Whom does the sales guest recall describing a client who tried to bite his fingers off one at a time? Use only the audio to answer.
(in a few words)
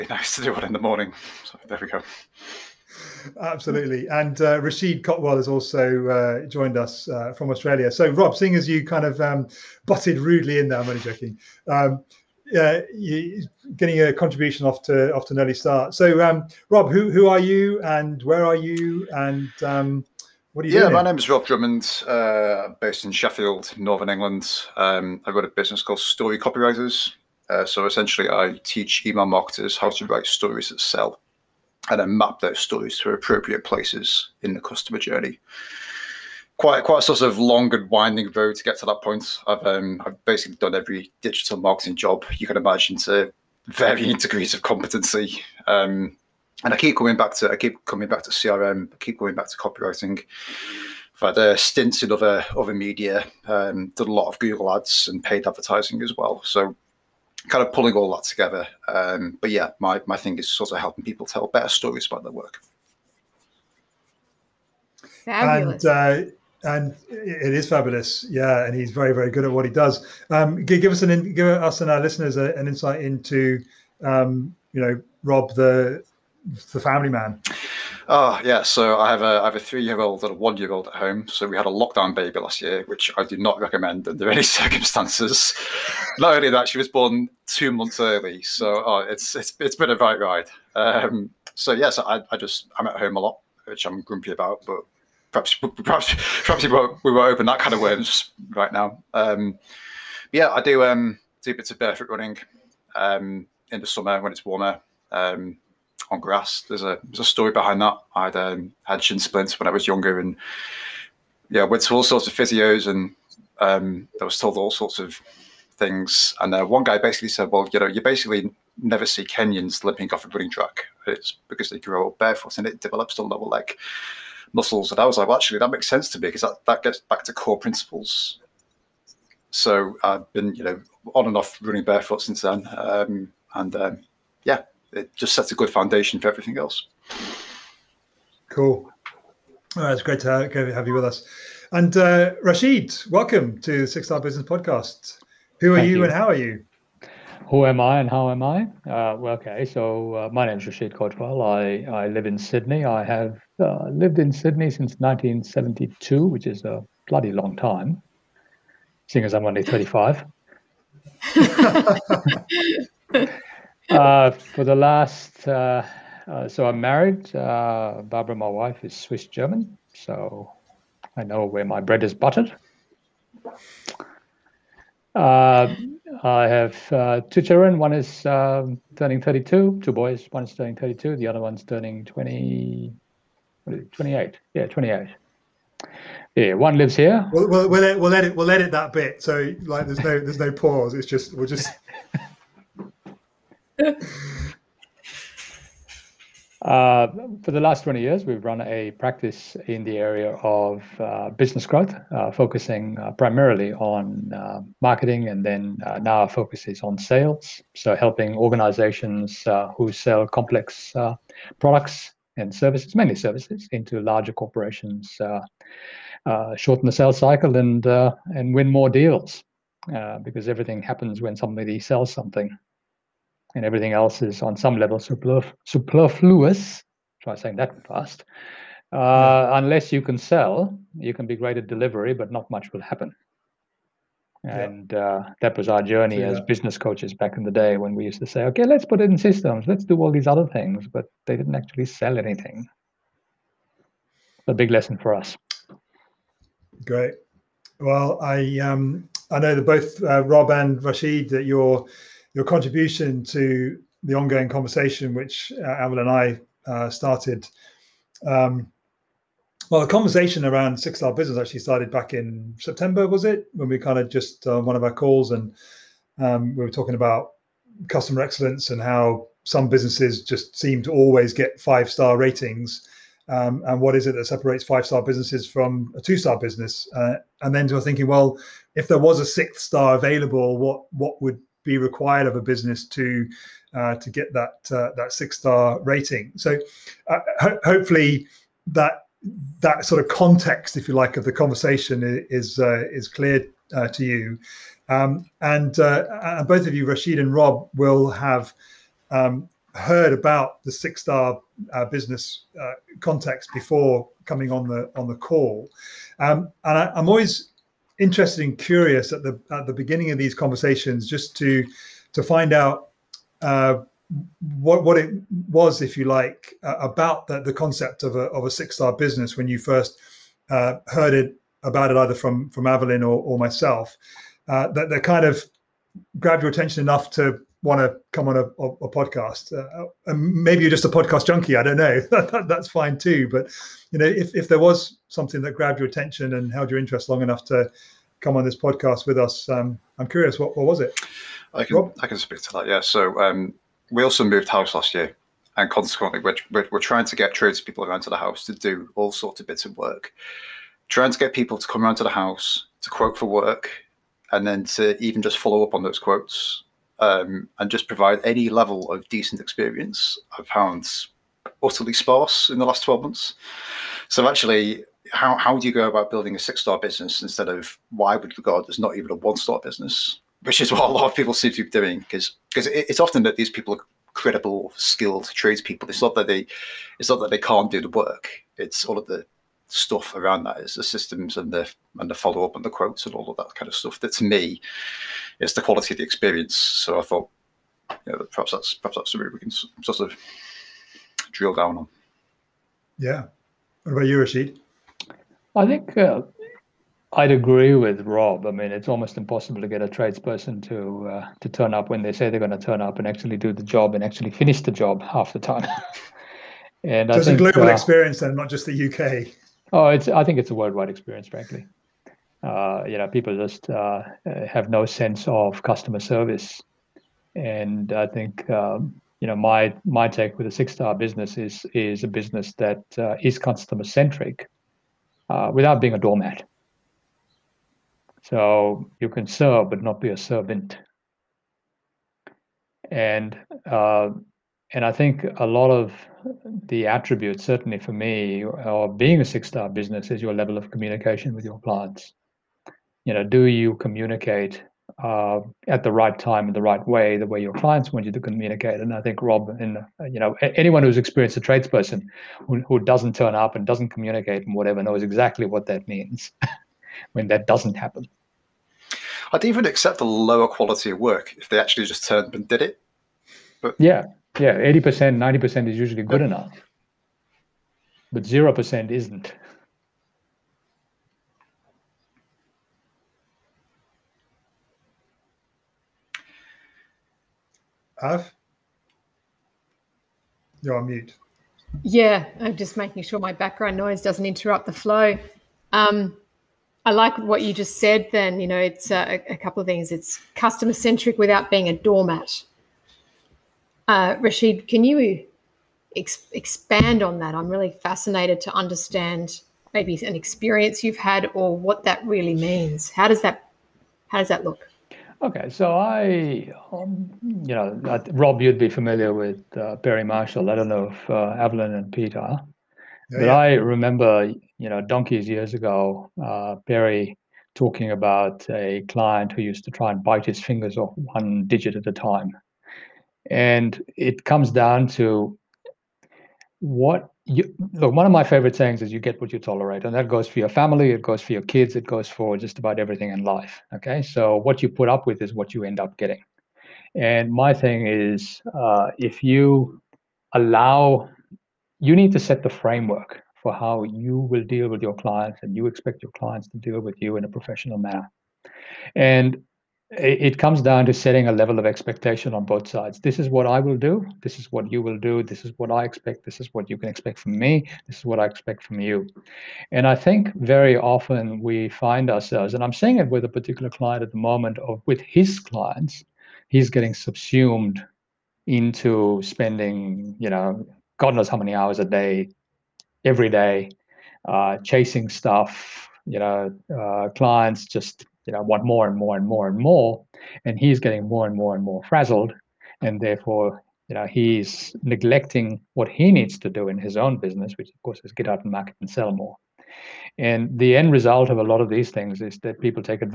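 Barry Marshall.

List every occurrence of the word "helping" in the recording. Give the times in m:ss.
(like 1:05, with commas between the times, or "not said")
1:00, 3:27.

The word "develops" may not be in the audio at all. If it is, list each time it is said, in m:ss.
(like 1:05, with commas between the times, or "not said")
2:02.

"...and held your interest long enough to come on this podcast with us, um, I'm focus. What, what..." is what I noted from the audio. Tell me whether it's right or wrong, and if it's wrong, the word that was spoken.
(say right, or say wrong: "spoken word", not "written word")
wrong: "curious", not "focus".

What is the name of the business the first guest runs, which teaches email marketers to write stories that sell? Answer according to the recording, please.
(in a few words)
Story Copywriters.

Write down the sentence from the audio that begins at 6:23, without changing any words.
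That to me is the quality of the experience.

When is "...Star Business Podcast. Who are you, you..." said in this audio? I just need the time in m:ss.
2:24.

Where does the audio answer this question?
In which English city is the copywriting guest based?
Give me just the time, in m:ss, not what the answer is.
0:23.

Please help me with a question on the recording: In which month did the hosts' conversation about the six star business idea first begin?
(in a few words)
September.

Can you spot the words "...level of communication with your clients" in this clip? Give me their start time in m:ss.
7:20.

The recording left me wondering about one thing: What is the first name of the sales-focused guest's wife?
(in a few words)
Barbara.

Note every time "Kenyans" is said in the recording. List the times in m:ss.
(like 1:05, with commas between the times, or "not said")
1:59.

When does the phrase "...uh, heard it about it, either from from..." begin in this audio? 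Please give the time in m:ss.
5:20.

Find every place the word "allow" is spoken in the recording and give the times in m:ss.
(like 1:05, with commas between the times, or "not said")
9:00.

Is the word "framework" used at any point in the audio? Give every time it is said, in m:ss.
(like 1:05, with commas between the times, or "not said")
9:02.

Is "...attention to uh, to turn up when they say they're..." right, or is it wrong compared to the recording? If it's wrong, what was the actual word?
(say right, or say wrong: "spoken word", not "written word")
wrong: "tradesperson", not "attention".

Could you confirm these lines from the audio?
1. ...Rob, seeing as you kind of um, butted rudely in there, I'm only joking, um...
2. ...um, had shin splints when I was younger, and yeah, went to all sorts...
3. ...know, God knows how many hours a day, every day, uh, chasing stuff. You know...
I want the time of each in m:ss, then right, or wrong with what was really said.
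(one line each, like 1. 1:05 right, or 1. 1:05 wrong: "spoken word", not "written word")
1. 0:08 right
2. 1:48 right
3. 9:30 right.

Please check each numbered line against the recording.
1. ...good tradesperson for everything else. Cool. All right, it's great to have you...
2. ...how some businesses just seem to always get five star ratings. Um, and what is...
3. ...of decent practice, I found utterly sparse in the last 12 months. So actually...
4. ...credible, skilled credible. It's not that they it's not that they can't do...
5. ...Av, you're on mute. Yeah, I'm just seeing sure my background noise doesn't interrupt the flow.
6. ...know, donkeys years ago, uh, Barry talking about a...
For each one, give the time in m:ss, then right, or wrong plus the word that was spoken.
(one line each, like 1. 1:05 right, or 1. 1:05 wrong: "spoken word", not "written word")
1. 2:15 wrong: "foundation", not "tradesperson"
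2. 4:28 right
3. 5:58 wrong: "experience", not "practice"
4. 6:14 wrong: "tradespeople", not "credible"
5. 7:57 wrong: "making", not "seeing"
6. 8:34 right.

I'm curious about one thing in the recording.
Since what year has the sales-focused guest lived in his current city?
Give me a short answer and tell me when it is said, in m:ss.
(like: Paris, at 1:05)
1972, at 2:34.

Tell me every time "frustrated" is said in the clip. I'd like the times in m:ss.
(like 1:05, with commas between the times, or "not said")
not said.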